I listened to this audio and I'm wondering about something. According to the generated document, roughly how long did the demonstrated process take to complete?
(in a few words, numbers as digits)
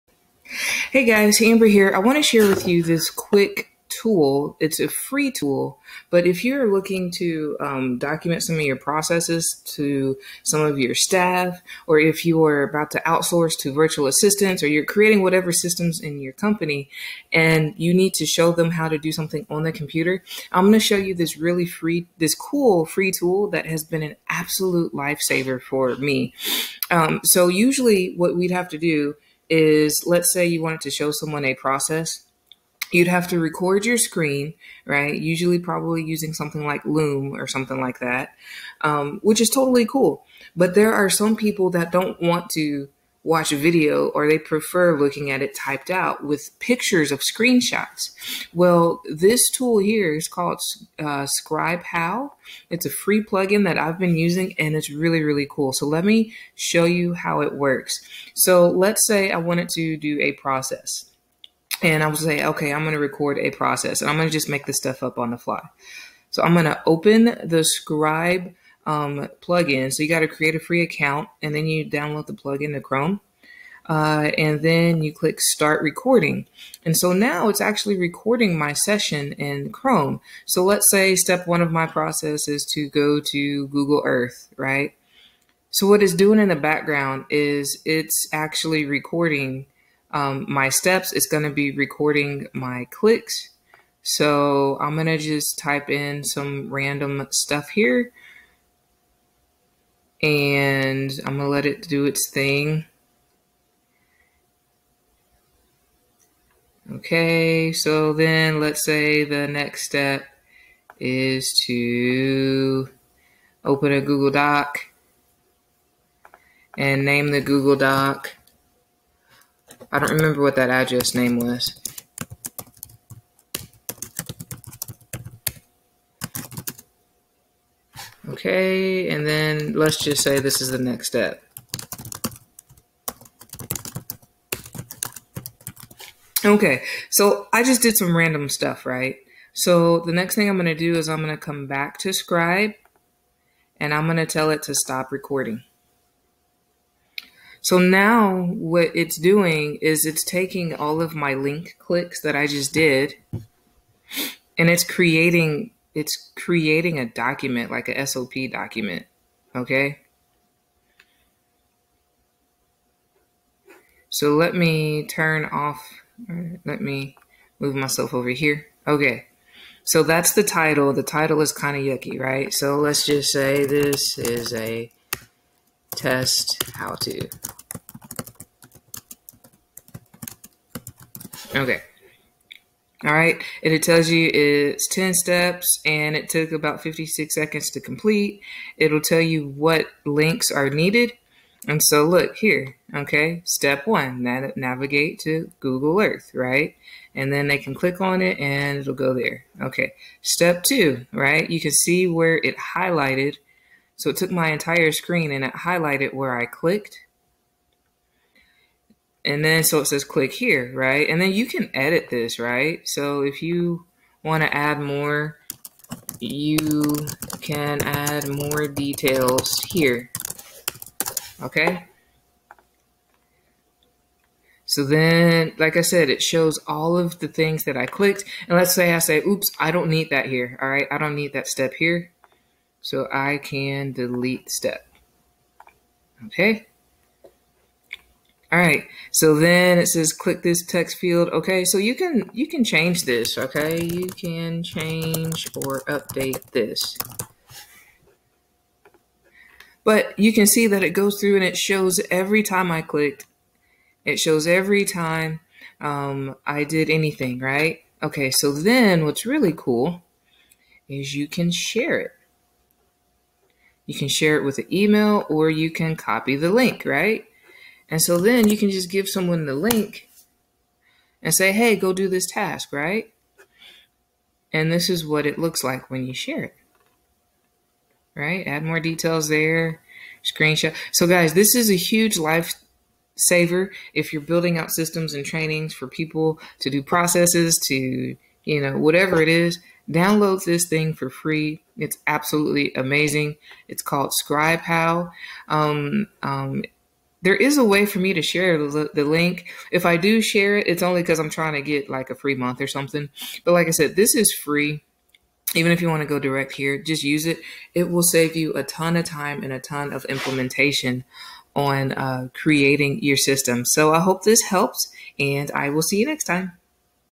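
56 seconds.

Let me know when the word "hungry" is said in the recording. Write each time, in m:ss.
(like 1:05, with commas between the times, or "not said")
not said.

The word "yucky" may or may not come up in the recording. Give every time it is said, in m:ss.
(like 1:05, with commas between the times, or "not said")
2:51.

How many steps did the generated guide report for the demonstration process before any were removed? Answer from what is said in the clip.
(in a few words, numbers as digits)
10.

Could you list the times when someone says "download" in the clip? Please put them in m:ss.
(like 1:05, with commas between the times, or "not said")
1:11, 4:49.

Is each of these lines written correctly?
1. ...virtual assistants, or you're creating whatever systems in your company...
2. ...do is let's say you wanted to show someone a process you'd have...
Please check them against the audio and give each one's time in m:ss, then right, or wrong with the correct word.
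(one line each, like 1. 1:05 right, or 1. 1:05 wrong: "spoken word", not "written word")
1. 0:13 right
2. 0:28 right.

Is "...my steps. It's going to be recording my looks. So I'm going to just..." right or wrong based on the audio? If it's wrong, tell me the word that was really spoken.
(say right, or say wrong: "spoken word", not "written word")
wrong: "clicks", not "looks".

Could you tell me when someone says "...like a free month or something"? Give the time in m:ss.
5:01.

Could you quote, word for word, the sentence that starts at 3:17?
And then they can click on it and it'll go there.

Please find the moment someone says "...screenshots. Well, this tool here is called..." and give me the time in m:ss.
0:47.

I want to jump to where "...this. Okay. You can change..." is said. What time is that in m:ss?
4:03.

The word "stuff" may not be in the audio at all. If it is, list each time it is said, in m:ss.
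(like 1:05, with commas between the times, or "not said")
1:04, 1:37, 2:18.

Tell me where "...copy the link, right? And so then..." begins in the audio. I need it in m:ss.
4:25.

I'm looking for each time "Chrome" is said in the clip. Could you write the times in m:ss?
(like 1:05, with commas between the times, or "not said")
1:12, 1:19.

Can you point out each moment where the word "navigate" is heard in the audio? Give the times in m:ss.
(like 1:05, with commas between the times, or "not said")
3:14.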